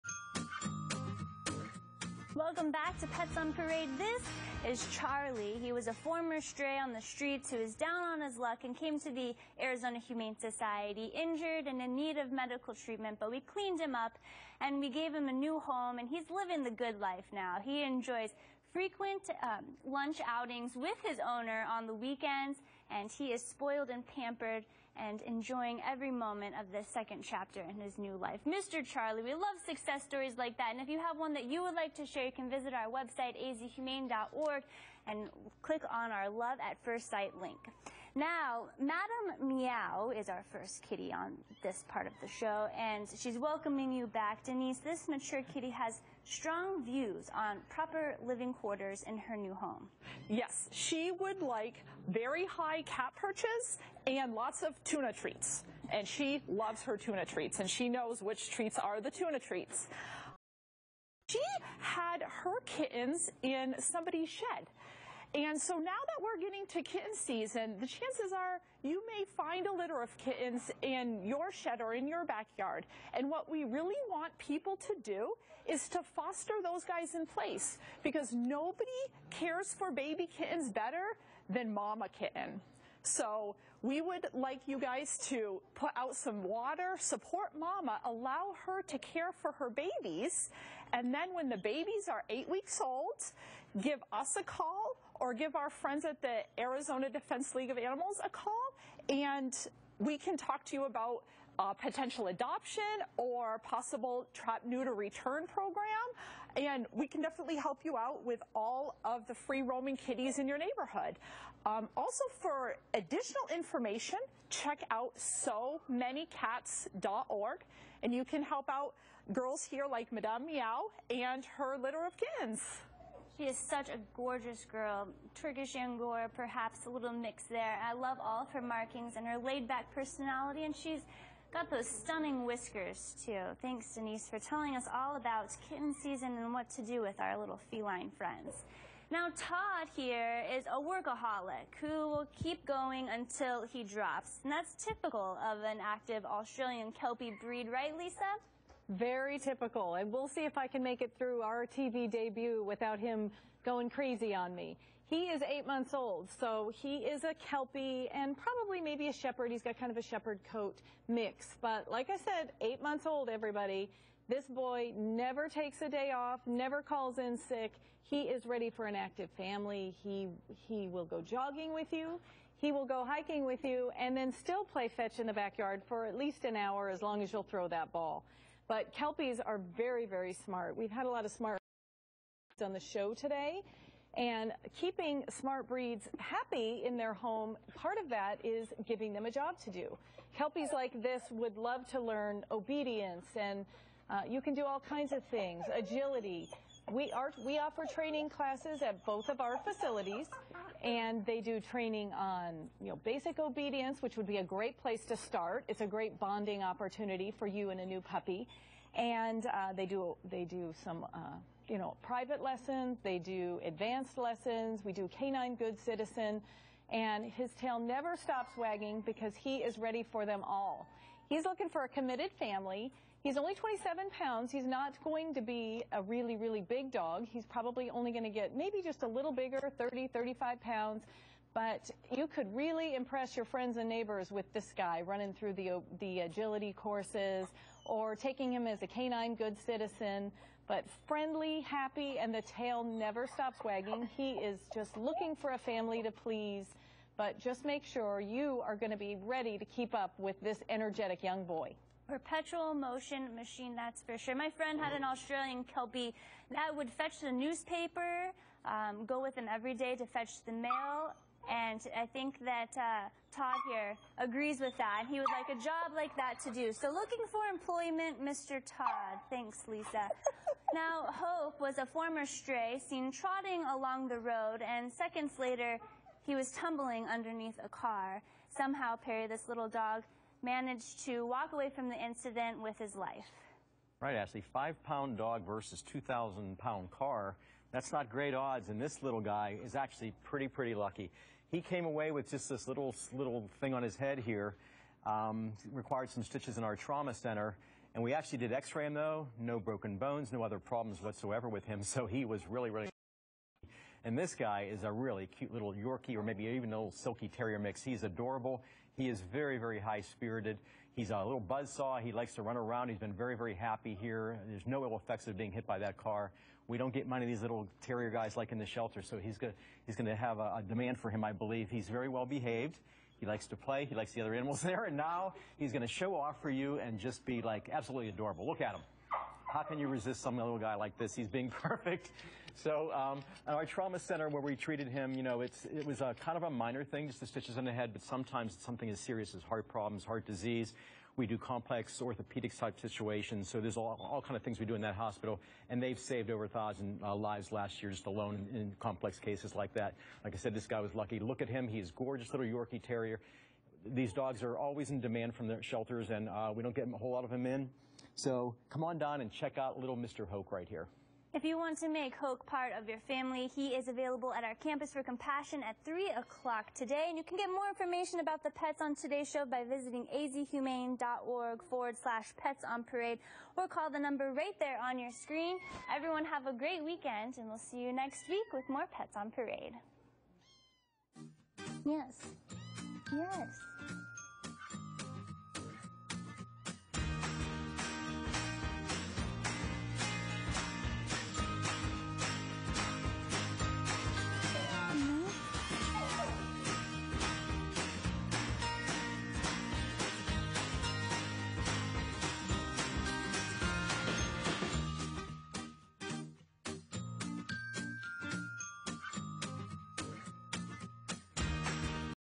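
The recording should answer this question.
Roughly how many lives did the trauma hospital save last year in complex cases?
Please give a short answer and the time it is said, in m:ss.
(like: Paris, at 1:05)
over 1,000, at 5:46.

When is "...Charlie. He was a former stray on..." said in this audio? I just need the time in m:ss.
0:04.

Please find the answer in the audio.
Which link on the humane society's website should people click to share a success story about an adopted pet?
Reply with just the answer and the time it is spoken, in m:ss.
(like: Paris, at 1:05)
Love at First Sight, at 0:36.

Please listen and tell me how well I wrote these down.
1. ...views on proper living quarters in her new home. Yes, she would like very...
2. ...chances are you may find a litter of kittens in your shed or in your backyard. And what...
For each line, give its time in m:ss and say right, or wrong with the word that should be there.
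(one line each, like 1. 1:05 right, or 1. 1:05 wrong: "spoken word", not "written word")
1. 0:46 right
2. 1:07 right.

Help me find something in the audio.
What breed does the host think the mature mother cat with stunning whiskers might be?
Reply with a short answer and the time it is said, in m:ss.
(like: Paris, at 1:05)
Turkish Angora, at 2:05.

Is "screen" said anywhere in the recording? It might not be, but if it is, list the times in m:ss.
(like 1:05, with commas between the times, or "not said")
6:15.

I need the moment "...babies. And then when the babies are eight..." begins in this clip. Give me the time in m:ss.
1:29.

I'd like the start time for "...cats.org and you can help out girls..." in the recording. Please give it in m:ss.
1:56.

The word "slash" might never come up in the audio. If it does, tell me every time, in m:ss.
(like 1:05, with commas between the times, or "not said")
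6:11.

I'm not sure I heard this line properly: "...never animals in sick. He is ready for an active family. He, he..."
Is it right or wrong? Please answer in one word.
wrong.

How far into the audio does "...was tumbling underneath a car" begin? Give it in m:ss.
4:36.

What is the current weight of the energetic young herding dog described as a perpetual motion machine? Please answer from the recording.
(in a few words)
27 pounds.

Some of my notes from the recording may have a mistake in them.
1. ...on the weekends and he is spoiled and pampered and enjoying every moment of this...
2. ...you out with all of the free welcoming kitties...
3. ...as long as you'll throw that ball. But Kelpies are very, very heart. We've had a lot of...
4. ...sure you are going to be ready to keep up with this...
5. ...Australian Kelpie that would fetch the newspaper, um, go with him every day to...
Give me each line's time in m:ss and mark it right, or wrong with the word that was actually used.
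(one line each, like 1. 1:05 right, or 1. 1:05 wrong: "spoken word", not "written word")
1. 0:21 right
2. 1:47 wrong: "roaming", not "welcoming"
3. 2:56 wrong: "smart", not "heart"
4. 4:07 right
5. 4:15 right.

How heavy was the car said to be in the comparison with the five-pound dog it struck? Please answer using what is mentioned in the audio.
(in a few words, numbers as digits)
2,000 pounds.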